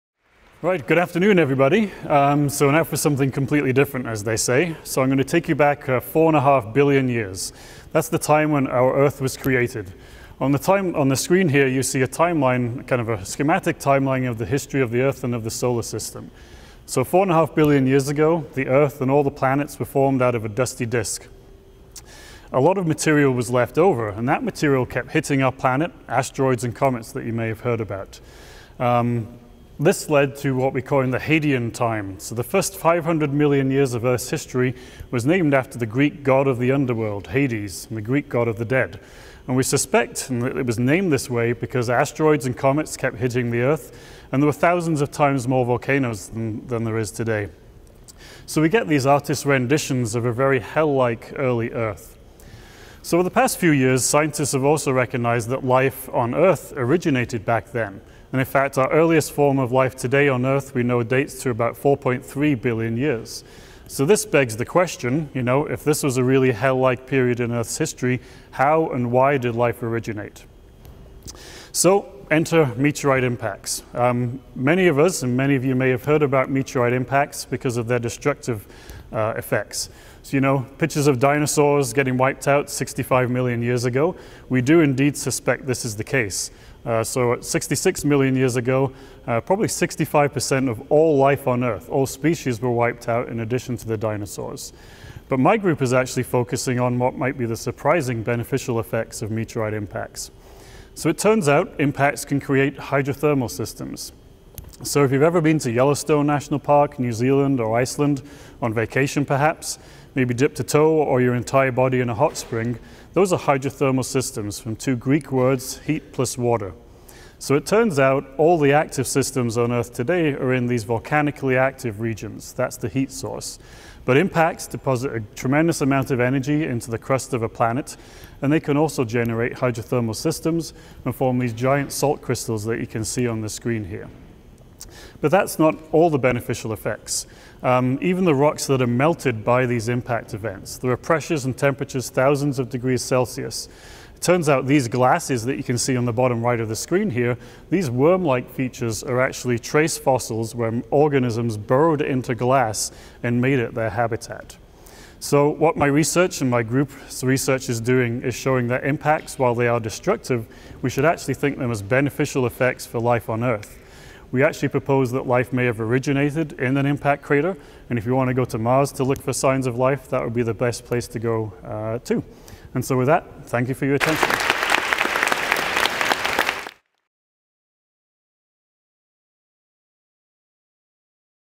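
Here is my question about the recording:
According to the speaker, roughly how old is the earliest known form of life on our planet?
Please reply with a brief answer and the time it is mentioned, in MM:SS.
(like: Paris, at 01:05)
4.3 billion years, at 01:01.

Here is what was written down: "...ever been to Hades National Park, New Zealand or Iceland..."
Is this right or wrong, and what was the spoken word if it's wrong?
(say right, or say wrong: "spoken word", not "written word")
wrong: "Yellowstone", not "Hades".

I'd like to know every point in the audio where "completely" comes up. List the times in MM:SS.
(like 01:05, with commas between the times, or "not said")
00:03.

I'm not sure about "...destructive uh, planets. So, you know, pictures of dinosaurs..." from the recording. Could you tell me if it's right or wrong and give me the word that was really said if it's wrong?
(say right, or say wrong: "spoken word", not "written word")
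wrong: "effects", not "planets".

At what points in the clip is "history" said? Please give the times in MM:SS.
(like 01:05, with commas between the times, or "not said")
00:14, 00:34, 01:07.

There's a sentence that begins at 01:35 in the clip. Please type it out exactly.
But my group is actually focusing on what might be the surprising beneficial effects of meteorite impacts.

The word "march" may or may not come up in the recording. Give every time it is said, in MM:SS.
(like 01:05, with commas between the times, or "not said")
not said.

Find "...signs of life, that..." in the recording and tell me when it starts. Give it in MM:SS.
02:49.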